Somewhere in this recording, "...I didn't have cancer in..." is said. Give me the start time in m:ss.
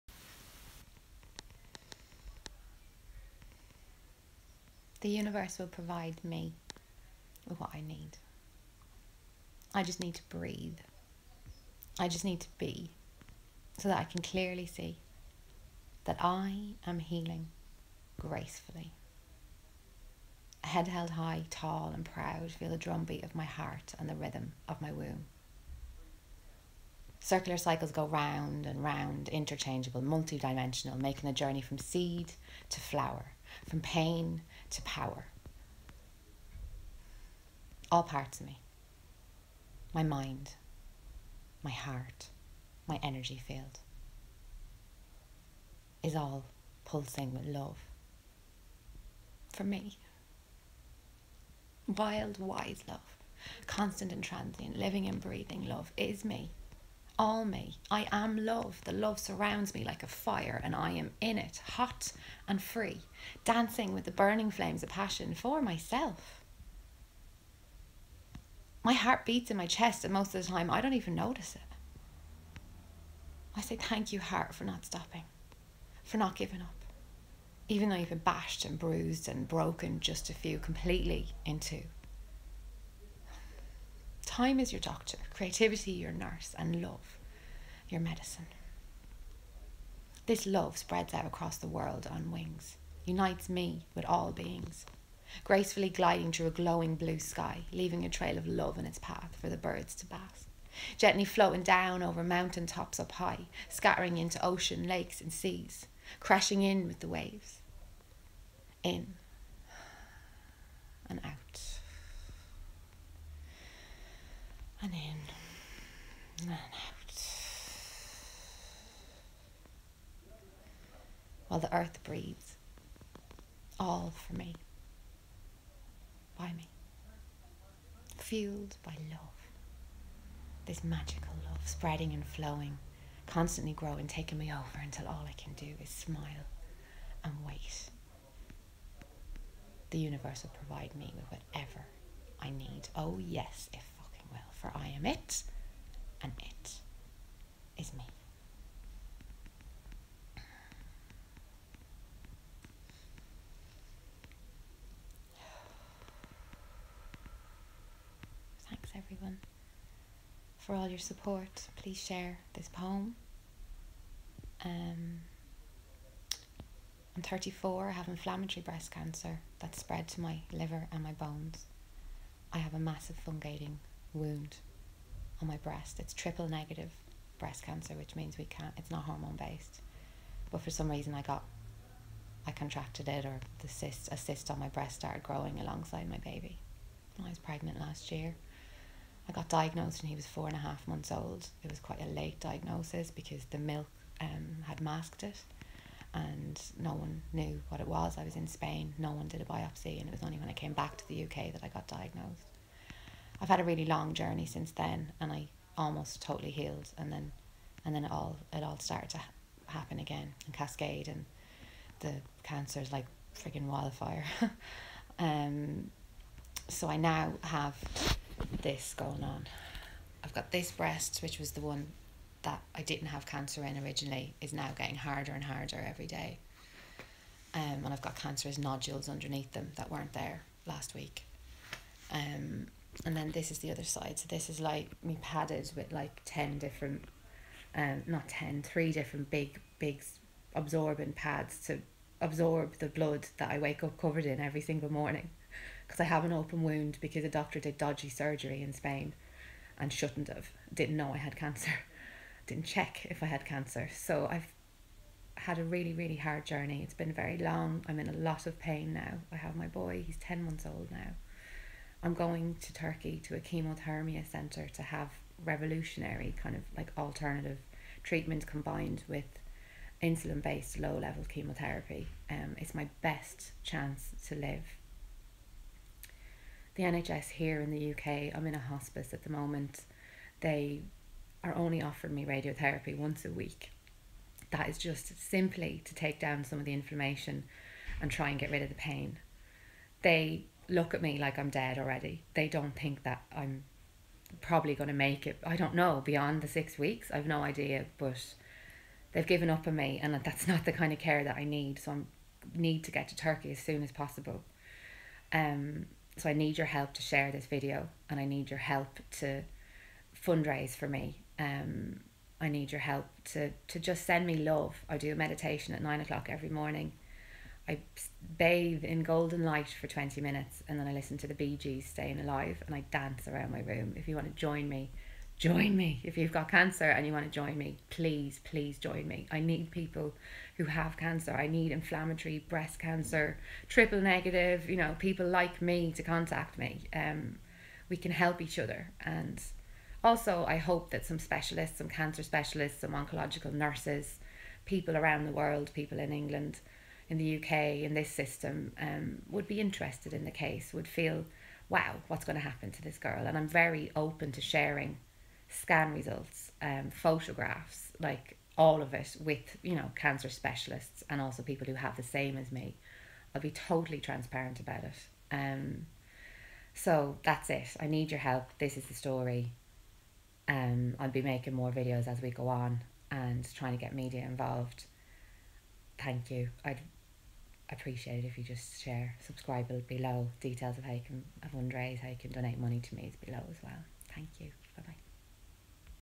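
3:42.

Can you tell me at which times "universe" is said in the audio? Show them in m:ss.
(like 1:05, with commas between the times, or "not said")
0:05, 2:19.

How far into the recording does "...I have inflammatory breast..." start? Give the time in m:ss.
2:47.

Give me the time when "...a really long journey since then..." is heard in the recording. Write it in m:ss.
3:23.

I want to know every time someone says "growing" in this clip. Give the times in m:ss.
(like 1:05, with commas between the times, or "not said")
2:13, 3:05.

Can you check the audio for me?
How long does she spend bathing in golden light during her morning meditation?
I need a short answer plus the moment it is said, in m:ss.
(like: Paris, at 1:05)
20 minutes, at 5:19.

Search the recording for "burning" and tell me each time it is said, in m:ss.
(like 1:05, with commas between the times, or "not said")
1:04.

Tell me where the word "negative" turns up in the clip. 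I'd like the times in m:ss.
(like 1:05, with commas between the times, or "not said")
2:56, 5:33.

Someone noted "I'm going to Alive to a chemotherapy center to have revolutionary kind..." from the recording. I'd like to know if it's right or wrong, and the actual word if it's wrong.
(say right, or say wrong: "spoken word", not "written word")
wrong: "Turkey", not "Alive".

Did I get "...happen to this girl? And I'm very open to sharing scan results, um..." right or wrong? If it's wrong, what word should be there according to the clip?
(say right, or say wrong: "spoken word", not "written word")
right.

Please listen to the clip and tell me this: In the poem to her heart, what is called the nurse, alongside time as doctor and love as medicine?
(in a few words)
creativity.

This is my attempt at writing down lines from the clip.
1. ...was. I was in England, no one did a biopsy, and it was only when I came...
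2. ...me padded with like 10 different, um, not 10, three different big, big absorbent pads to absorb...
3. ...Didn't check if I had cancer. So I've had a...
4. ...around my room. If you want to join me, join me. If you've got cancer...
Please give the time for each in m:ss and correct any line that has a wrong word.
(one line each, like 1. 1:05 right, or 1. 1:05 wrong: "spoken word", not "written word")
1. 3:17 wrong: "Spain", not "England"
2. 3:55 right
3. 4:12 right
4. 5:23 right.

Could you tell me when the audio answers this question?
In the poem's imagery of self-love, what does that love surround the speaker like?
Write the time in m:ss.
1:00.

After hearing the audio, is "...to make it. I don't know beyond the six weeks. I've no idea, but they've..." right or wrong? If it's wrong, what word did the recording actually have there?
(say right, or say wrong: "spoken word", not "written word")
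right.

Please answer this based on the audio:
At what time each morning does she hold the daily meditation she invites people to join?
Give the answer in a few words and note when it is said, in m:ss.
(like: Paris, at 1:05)
9 o'clock, at 5:15.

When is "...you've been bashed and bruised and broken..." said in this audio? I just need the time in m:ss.
1:17.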